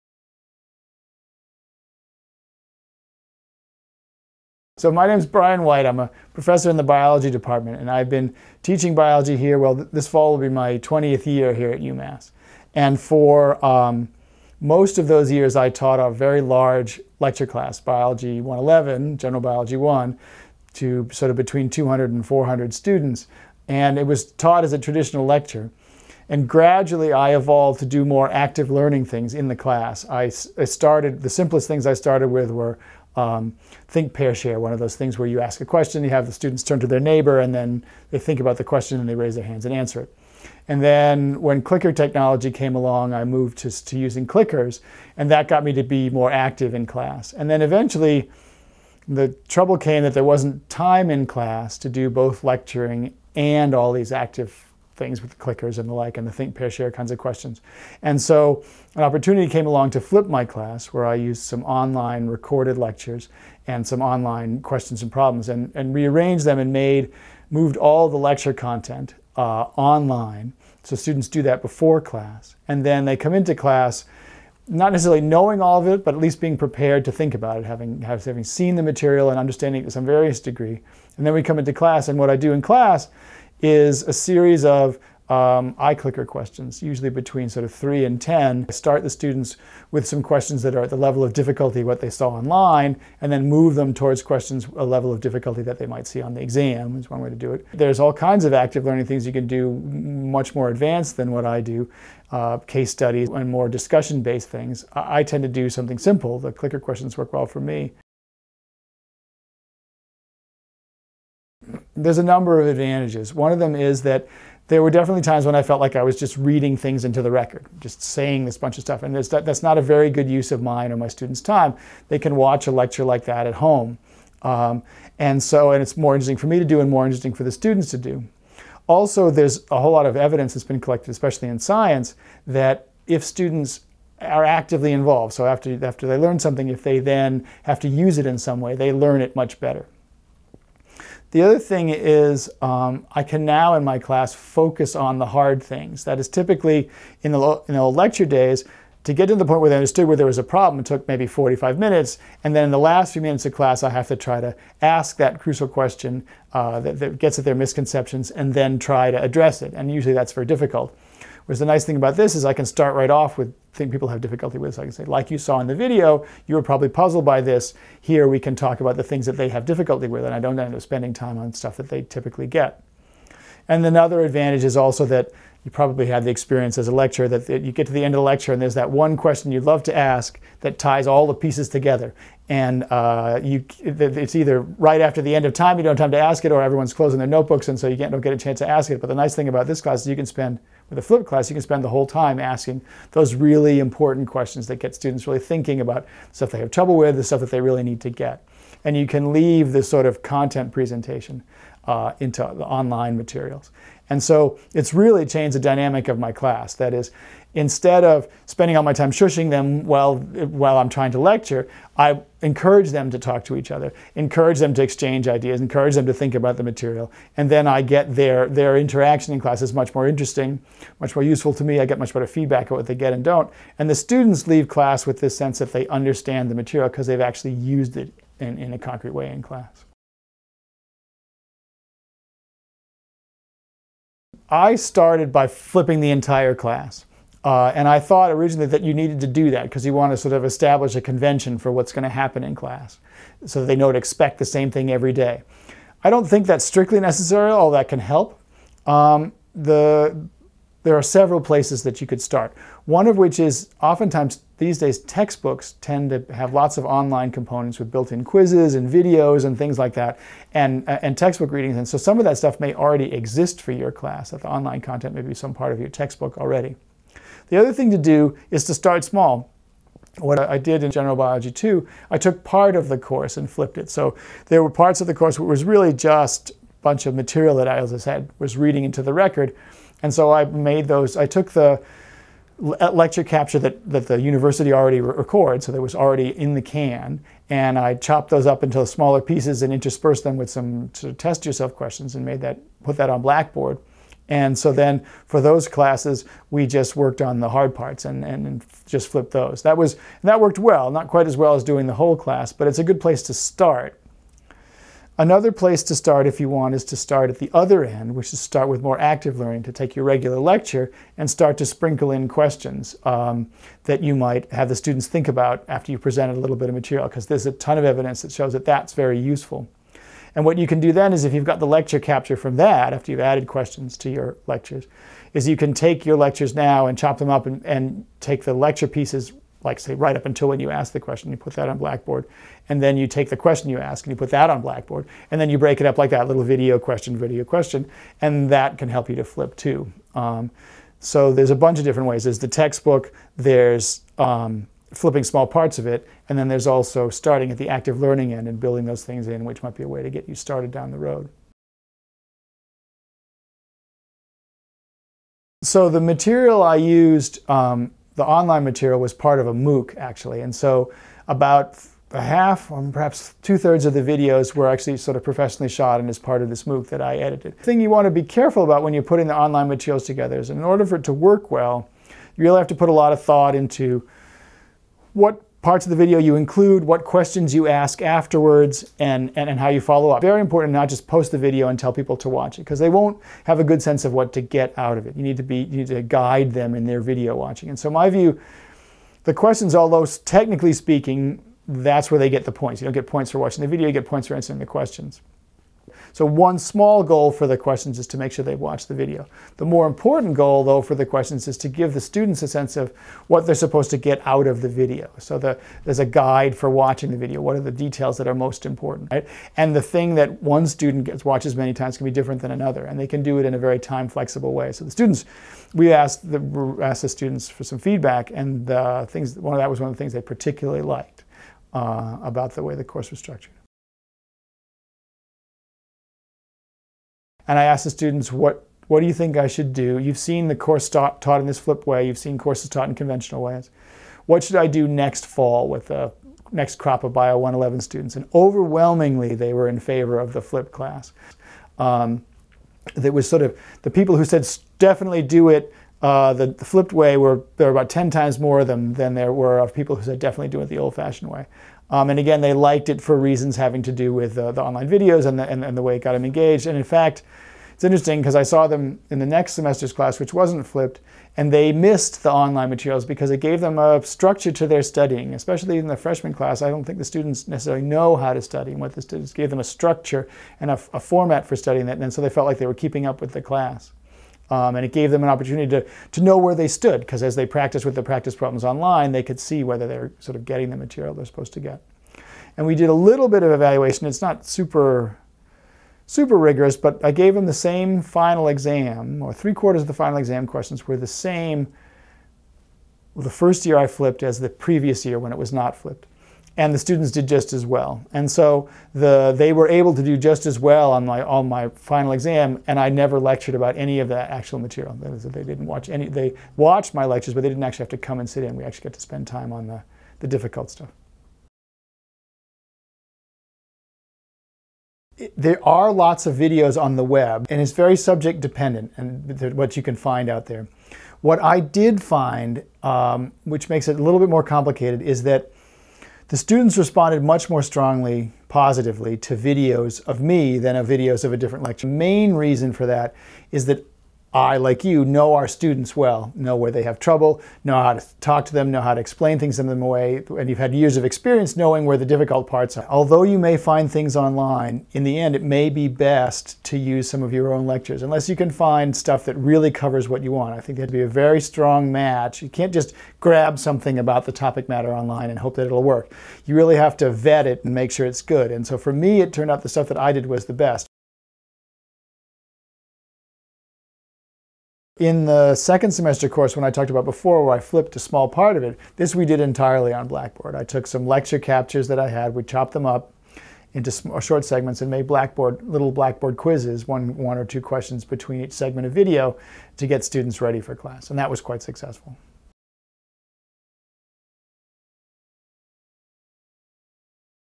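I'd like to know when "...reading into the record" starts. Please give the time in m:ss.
4:38.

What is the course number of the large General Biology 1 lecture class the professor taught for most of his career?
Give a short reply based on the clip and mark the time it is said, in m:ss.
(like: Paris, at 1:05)
Biology 111, at 0:17.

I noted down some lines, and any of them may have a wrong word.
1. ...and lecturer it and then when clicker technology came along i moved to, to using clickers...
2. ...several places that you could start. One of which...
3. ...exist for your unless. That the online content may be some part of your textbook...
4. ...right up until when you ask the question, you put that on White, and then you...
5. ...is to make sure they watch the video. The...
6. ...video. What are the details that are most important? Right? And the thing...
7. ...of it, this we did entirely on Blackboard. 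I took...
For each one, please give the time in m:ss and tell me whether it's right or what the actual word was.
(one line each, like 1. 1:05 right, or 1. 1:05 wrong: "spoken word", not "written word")
1. 0:39 wrong: "answer", not "lecturer"
2. 4:11 right
3. 4:23 wrong: "class", not "unless"
4. 5:29 wrong: "Blackboard", not "White"
5. 6:37 right
6. 6:47 right
7. 9:28 right.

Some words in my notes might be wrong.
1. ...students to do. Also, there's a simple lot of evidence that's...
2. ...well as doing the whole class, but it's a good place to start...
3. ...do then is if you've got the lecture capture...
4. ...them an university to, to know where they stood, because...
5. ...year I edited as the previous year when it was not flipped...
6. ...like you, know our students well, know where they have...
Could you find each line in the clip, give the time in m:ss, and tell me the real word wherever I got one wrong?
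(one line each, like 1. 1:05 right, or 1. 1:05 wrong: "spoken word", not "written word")
1. 2:07 wrong: "whole", not "simple"
2. 5:01 right
3. 5:20 right
4. 7:55 wrong: "opportunity", not "university"
5. 8:13 wrong: "flipped", not "edited"
6. 8:54 right.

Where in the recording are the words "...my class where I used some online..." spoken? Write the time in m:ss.
1:00.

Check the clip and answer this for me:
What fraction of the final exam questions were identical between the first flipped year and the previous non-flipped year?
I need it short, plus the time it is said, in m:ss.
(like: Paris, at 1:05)
three quarters, at 8:09.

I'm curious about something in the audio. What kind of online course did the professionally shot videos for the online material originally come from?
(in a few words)
a MOOC.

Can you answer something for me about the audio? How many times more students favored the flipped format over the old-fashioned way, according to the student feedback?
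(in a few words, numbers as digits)
10.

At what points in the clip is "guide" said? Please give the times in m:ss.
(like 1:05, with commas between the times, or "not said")
6:26, 6:46.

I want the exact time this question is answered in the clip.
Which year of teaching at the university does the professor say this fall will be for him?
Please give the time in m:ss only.
0:10.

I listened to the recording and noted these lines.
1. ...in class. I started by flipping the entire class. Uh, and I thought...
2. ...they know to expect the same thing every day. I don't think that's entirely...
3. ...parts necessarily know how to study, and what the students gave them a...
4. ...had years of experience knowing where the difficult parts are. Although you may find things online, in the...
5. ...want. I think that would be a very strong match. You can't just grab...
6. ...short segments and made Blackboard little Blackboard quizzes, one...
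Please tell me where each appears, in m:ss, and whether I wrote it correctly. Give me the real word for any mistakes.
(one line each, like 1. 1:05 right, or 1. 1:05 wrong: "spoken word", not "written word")
1. 3:49 right
2. 4:03 wrong: "strictly", not "entirely"
3. 7:47 wrong: "students", not "parts"
4. 9:00 right
5. 9:10 right
6. 9:34 right.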